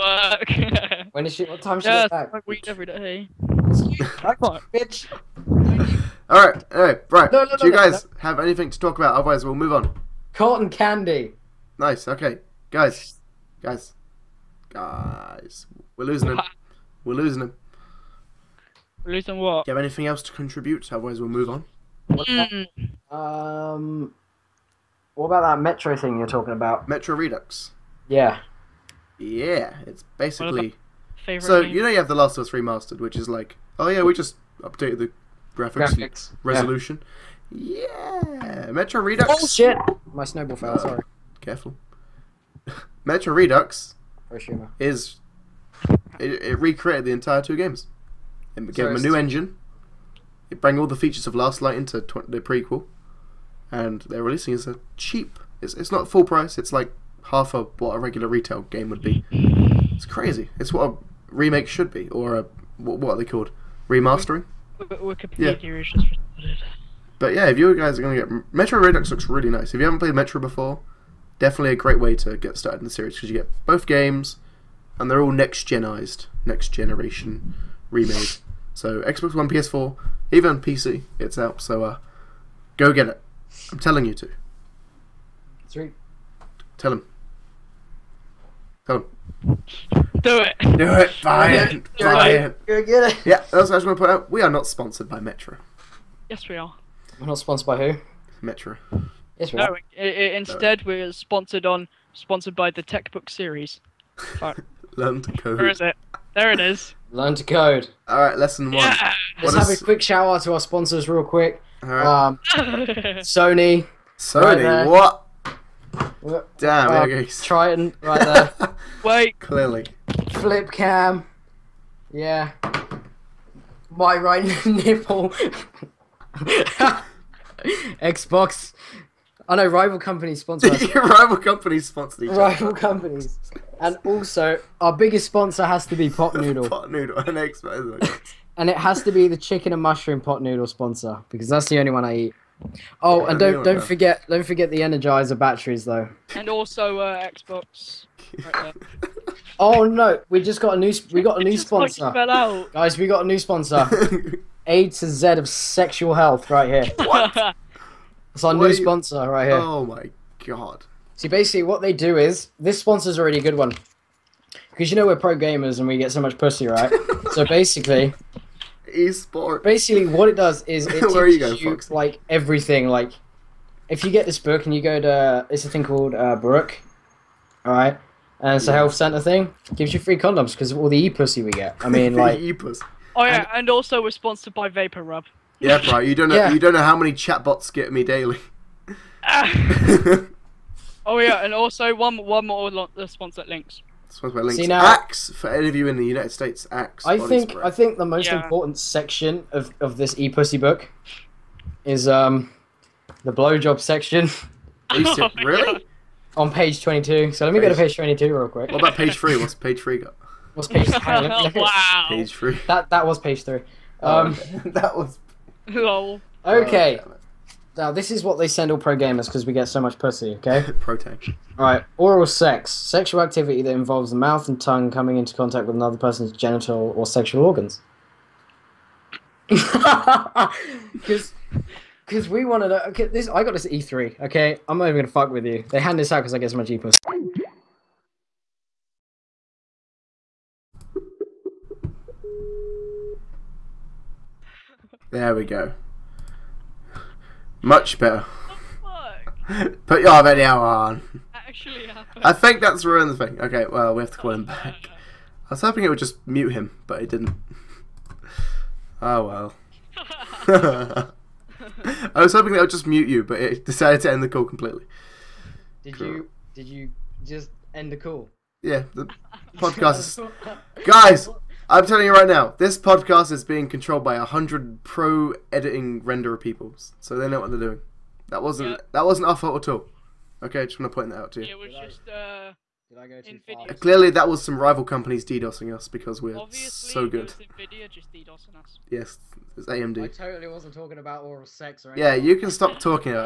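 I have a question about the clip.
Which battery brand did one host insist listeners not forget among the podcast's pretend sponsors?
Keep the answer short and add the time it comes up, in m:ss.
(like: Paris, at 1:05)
Energizer, at 2:24.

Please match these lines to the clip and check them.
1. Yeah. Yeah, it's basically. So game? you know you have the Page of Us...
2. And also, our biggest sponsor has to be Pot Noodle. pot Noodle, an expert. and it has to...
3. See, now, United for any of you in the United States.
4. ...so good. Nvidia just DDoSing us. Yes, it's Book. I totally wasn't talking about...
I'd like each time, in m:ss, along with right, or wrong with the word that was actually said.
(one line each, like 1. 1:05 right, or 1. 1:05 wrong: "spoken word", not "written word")
1. 0:28 wrong: "Last", not "Page"
2. 2:13 right
3. 3:14 wrong: "Axe", not "United"
4. 4:46 wrong: "AMD", not "Book".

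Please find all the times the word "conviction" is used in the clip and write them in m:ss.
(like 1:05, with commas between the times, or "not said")
not said.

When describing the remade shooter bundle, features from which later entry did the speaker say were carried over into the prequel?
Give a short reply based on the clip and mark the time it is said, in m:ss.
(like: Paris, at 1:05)
Last Light, at 0:51.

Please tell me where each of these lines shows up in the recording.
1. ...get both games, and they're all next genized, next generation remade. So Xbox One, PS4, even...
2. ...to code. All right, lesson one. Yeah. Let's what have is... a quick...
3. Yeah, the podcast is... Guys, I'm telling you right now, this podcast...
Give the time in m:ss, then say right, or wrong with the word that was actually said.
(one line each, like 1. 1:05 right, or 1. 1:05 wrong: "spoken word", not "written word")
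1. 1:13 right
2. 1:47 right
3. 4:28 right.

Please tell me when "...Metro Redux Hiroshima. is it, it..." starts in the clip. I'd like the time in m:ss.
0:43.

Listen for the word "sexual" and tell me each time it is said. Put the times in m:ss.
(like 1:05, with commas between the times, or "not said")
2:35, 3:42, 3:47.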